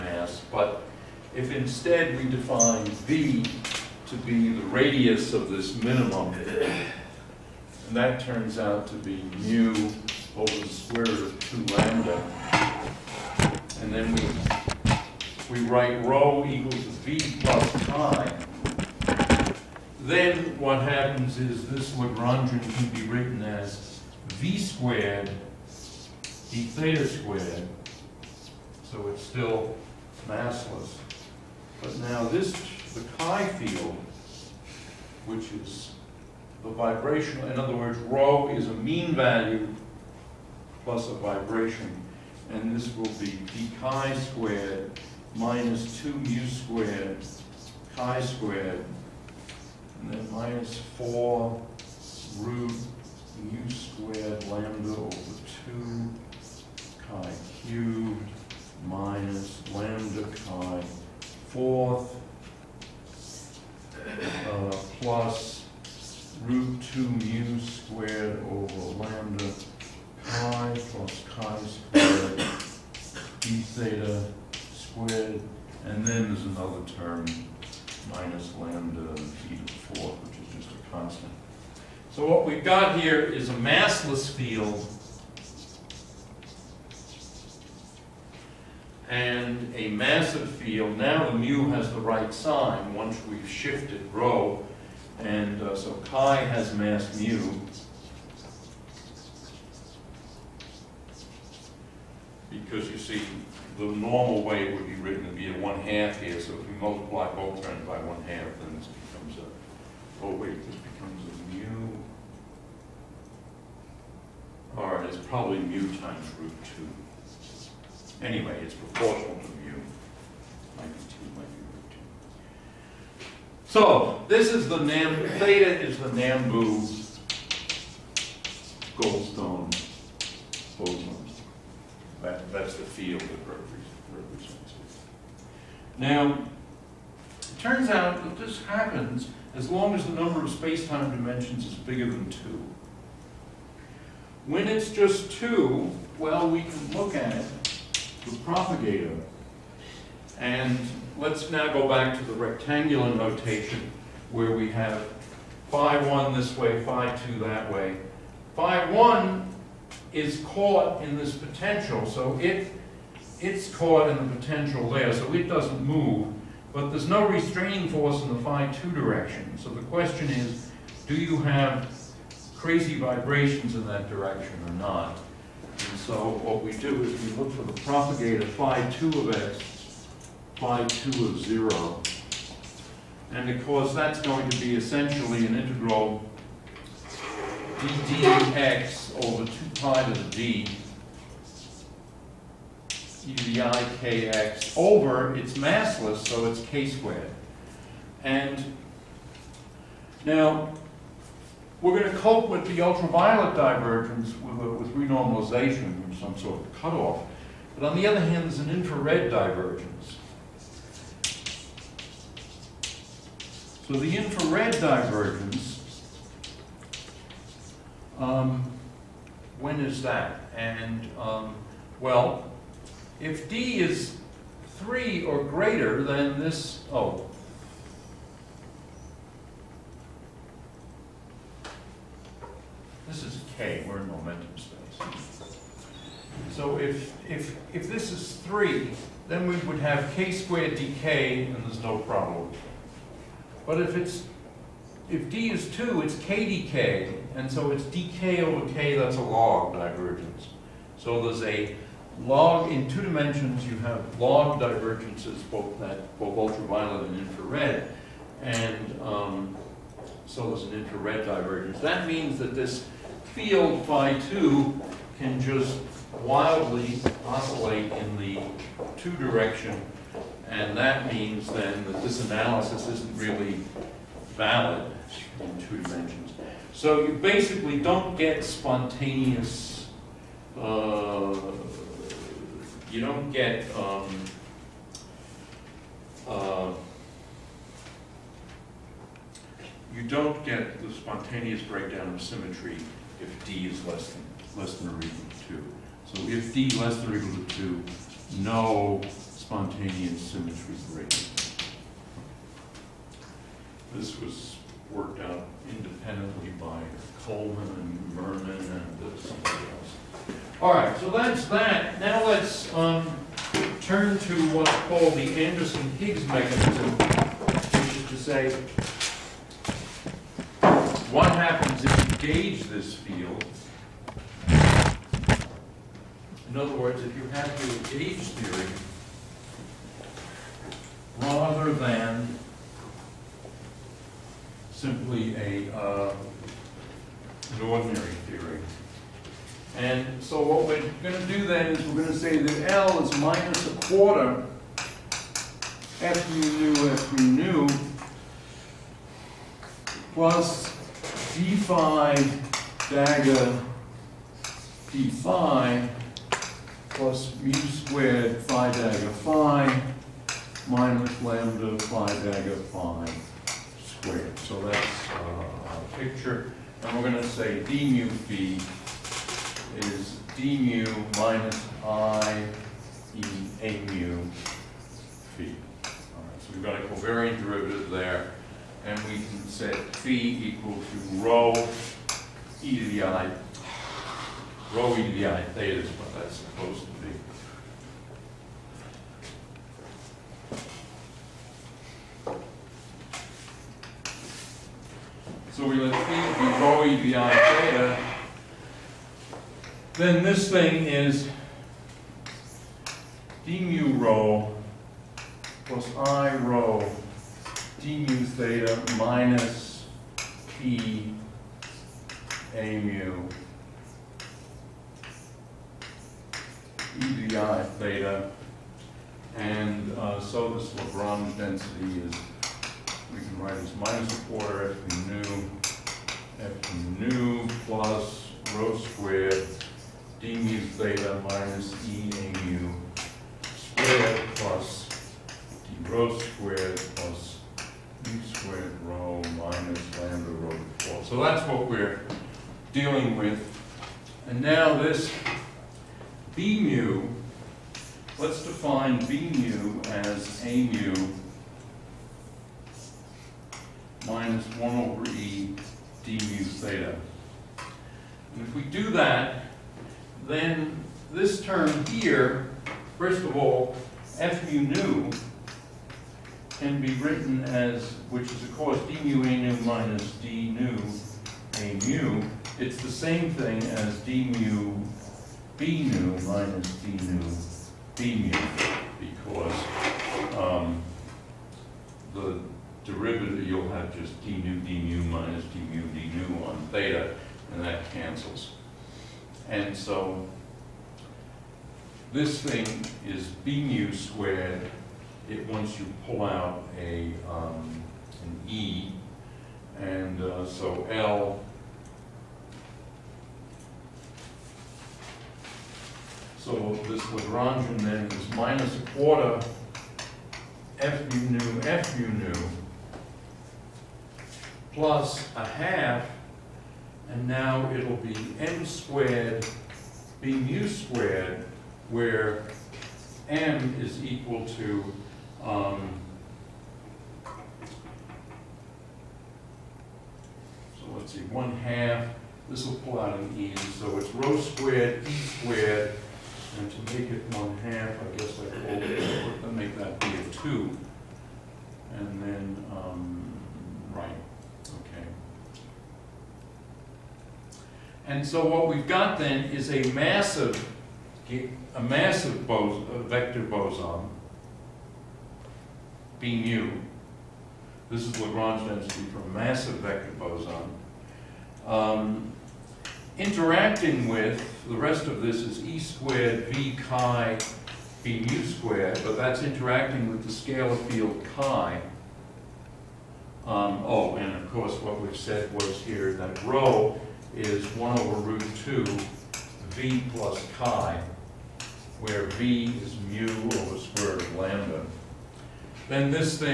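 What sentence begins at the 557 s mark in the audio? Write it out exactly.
This is Lagrange density for a massive vector boson.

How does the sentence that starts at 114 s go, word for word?
All right, it's probably mu times root 2.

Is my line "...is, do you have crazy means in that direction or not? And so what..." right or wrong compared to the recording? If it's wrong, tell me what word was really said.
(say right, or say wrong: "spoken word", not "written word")
wrong: "vibrations", not "means".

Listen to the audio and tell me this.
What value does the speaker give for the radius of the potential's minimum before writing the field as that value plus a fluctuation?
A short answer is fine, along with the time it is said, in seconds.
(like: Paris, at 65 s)
mu over root 2 lambda, at 9 s.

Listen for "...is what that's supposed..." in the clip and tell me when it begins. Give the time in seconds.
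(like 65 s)
385 s.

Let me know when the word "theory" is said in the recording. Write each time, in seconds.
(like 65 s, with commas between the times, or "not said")
328 s, 338 s.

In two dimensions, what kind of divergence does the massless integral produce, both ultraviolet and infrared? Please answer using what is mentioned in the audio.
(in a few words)
Log divergence.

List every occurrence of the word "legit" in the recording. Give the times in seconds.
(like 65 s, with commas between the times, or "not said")
not said.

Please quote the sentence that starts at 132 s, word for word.
That, that's the field that represents it.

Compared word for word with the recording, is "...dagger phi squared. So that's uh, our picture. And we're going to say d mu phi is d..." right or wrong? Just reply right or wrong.
right.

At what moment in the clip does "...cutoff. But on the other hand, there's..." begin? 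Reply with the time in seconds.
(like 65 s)
206 s.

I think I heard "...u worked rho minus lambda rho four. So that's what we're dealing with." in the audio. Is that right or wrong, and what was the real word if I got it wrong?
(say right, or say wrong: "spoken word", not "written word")
wrong: "squared", not "worked".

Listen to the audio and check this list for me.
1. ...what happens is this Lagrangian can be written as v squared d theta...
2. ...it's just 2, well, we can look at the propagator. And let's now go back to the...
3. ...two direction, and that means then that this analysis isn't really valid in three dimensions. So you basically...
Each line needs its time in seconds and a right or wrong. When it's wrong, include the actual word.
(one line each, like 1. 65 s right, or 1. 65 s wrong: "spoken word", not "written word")
1. 20 s right
2. 144 s right
3. 268 s wrong: "two", not "three".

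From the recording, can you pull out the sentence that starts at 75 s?
And then there's another term, minus lambda theta 4, which is just a constant.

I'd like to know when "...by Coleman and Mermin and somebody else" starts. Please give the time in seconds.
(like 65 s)
306 s.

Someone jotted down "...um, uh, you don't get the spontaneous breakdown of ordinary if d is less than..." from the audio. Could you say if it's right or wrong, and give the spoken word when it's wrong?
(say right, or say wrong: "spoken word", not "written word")
wrong: "symmetry", not "ordinary".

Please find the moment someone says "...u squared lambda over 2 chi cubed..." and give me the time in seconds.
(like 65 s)
53 s.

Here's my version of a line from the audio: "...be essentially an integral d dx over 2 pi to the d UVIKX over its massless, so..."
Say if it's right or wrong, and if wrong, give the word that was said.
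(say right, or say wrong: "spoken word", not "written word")
right.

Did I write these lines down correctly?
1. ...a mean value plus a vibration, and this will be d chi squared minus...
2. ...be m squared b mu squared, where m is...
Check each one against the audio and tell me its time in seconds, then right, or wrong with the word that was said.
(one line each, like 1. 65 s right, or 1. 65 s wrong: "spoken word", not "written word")
1. 38 s right
2. 517 s right.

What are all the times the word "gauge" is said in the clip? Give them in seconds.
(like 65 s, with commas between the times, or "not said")
322 s, 327 s.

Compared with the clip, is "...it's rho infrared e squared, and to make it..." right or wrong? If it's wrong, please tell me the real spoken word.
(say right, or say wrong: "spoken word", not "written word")
wrong: "squared", not "infrared".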